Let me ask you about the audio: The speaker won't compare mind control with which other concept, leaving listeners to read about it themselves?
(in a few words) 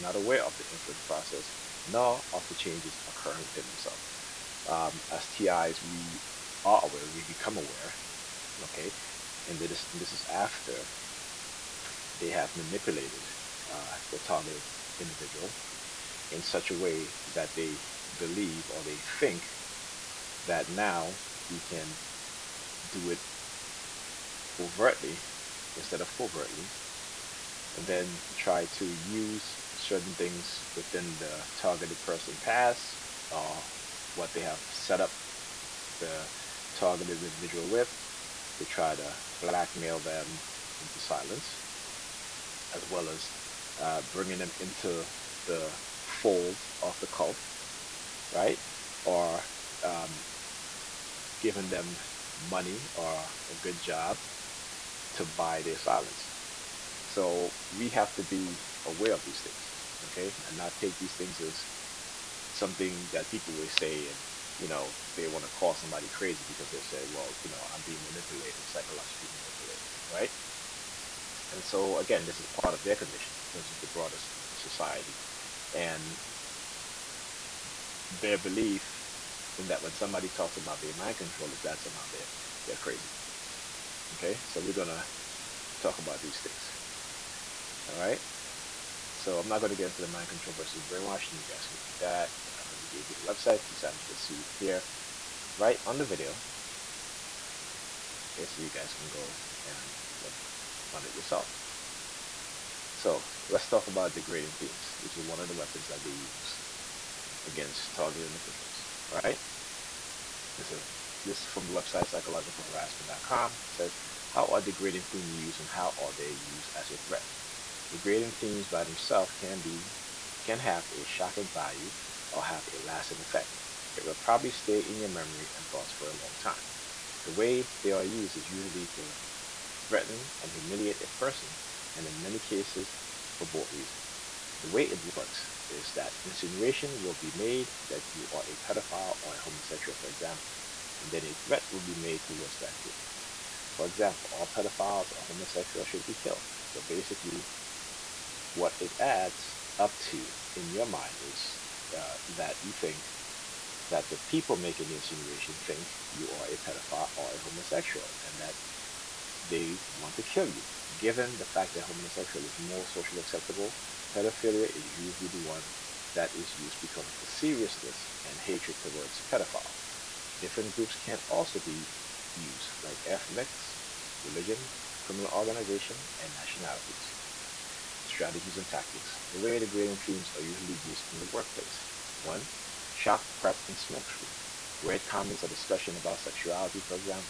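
Brainwashing.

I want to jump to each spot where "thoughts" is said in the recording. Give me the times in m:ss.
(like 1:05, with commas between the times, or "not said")
2:05.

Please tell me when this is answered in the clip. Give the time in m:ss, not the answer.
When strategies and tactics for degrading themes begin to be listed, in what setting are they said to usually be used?
3:01.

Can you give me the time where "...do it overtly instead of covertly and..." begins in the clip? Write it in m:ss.
0:22.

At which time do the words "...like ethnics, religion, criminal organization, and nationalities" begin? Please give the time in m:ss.
2:52.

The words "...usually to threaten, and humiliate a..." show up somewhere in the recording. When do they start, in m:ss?
2:08.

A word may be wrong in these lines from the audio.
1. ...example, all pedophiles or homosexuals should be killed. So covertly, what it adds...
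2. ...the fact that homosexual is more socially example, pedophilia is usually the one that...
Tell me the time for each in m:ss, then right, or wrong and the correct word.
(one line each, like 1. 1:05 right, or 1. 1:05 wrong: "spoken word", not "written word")
1. 2:23 wrong: "basically", not "covertly"
2. 2:41 wrong: "acceptable", not "example".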